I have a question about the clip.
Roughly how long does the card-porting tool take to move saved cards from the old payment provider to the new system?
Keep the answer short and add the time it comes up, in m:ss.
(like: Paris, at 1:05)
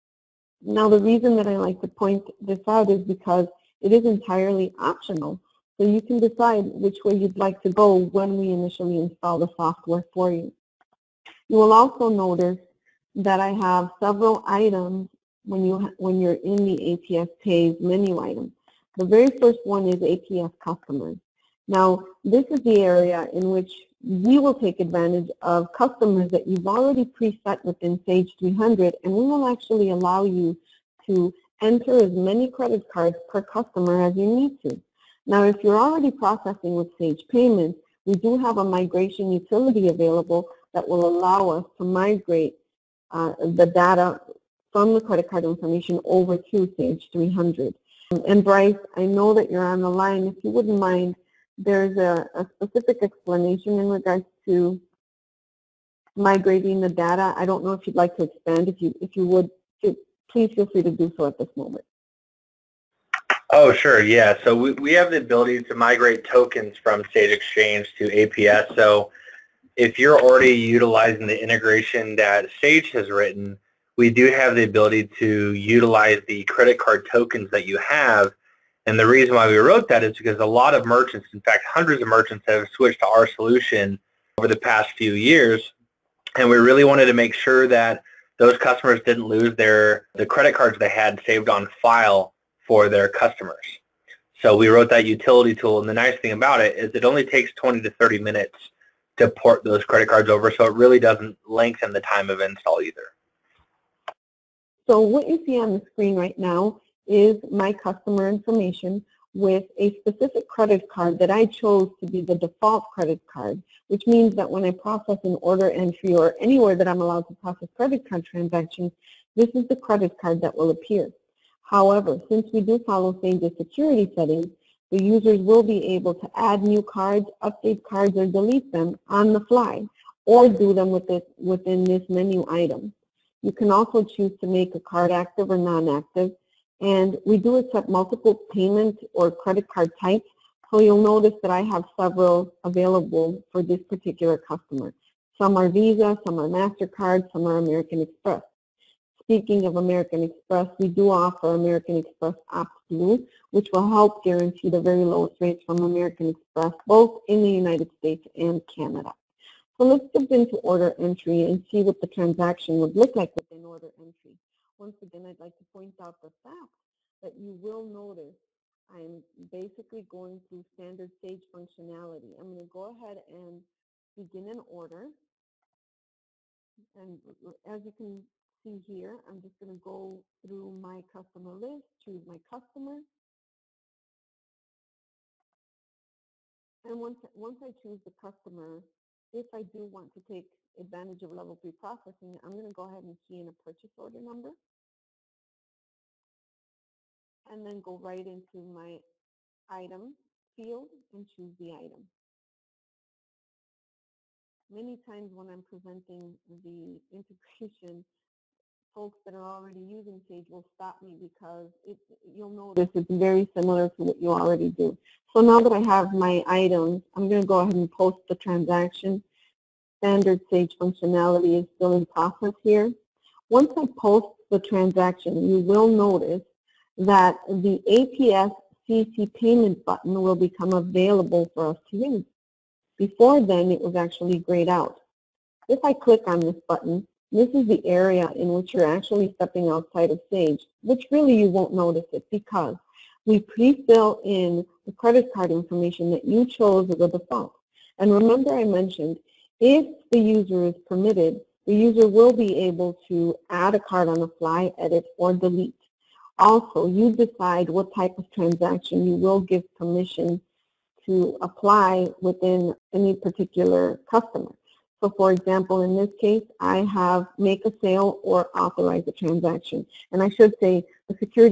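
20 to 30 minutes, at 1:37.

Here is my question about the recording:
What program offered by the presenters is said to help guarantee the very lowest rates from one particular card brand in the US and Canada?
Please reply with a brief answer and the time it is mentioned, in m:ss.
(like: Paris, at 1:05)
American Express Blue, at 2:31.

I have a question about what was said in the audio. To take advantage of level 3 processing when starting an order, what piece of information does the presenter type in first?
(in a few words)
purchase order number.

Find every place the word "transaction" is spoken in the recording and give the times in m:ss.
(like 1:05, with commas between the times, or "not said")
1:58, 2:42, 3:38, 3:44, 4:18, 4:29.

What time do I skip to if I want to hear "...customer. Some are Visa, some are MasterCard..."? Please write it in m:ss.
2:24.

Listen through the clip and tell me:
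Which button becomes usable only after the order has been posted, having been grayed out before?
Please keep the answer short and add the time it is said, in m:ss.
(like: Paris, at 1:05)
APS CC payment, at 3:47.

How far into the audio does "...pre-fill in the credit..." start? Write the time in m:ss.
4:03.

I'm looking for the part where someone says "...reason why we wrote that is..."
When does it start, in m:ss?
1:19.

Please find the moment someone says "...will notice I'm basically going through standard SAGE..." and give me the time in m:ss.
2:47.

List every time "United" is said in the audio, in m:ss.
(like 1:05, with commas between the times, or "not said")
2:37.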